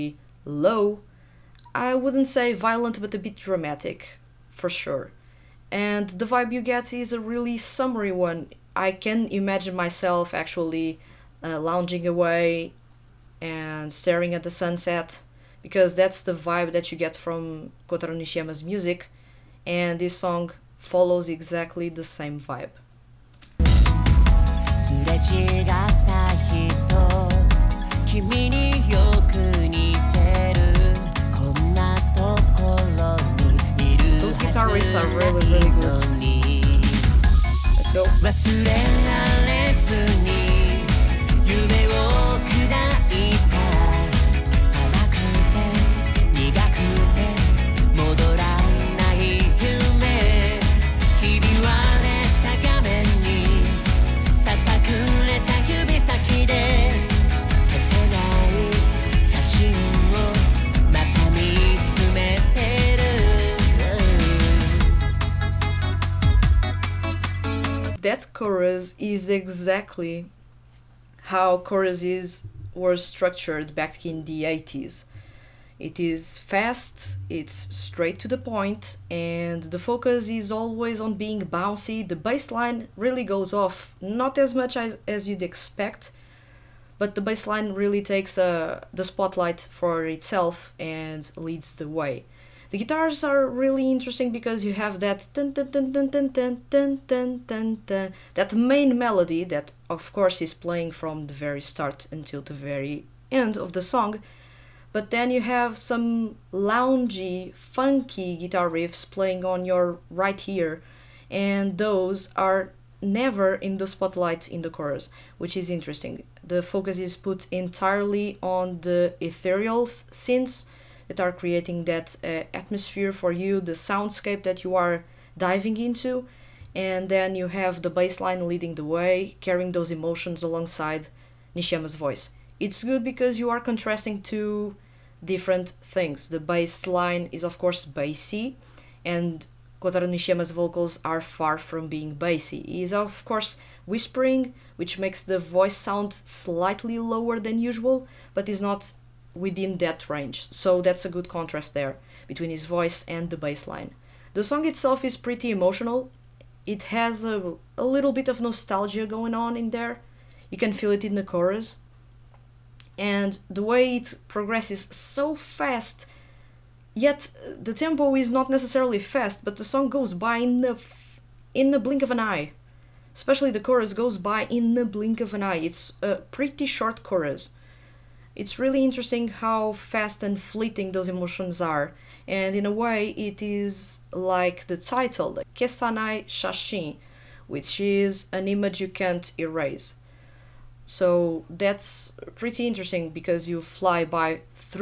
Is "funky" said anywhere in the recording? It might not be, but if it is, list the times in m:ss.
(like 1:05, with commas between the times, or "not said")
1:47.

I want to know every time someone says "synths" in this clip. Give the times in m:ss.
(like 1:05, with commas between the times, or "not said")
1:59.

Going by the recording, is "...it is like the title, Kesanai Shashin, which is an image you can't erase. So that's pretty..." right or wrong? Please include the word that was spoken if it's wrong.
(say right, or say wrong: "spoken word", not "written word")
right.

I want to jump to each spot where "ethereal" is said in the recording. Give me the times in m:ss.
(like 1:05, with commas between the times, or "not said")
1:59.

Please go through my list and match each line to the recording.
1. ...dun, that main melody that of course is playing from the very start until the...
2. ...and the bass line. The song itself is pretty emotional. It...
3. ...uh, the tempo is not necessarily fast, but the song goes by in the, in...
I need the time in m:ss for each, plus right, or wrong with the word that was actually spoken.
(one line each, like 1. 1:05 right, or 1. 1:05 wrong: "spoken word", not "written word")
1. 1:37 right
2. 2:33 right
3. 2:47 right.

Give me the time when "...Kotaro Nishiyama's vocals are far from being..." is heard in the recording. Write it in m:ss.
2:19.